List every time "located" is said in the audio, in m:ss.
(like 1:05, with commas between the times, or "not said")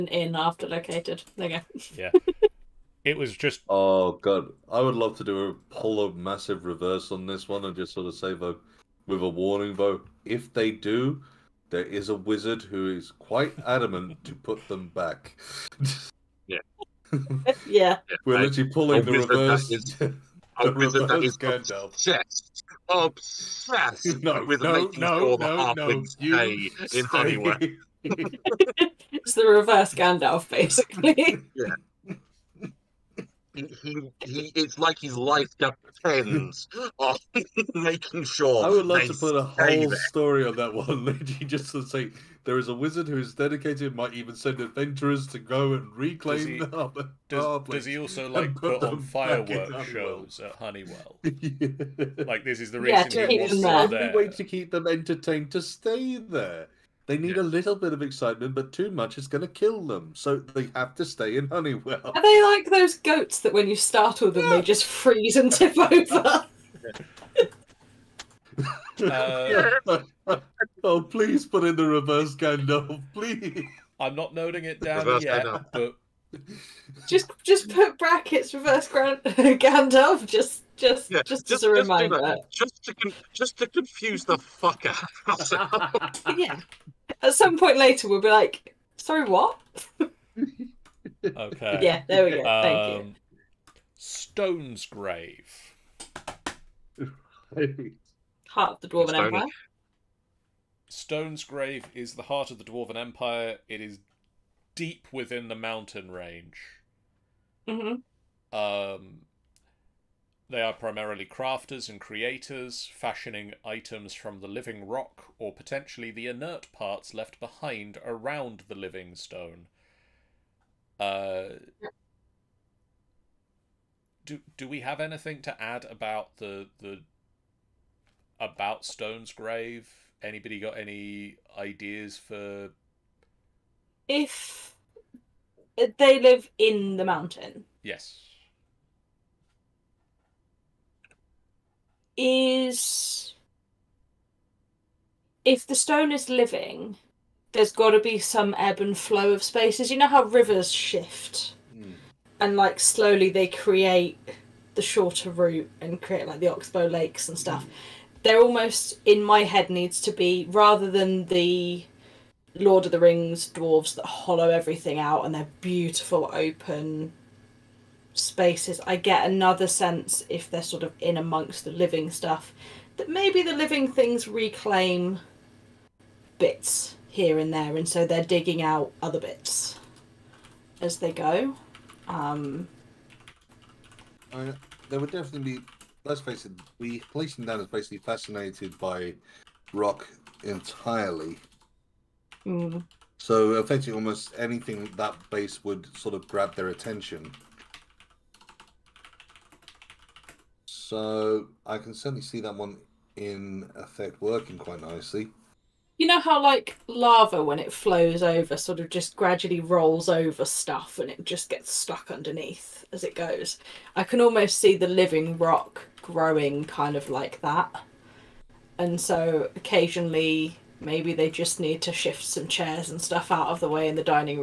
0:00.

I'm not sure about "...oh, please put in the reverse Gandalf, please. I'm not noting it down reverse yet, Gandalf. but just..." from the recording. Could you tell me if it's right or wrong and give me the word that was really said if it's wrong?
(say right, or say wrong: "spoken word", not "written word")
right.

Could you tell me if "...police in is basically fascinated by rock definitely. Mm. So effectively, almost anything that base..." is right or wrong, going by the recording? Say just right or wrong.
wrong.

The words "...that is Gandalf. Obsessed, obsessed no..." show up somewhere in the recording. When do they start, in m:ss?
0:21.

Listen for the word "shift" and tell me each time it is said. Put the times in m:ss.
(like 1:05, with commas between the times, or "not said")
2:30, 3:41.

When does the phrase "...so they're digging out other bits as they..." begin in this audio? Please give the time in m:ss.
2:57.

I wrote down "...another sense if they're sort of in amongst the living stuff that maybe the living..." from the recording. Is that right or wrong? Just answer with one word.
right.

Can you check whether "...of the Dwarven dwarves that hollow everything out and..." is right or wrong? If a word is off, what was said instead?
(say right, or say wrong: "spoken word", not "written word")
wrong: "Rings", not "Dwarven".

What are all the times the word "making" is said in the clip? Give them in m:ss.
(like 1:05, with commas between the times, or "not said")
0:24, 0:37.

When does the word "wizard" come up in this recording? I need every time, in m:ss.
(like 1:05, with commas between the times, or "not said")
0:12, 0:42.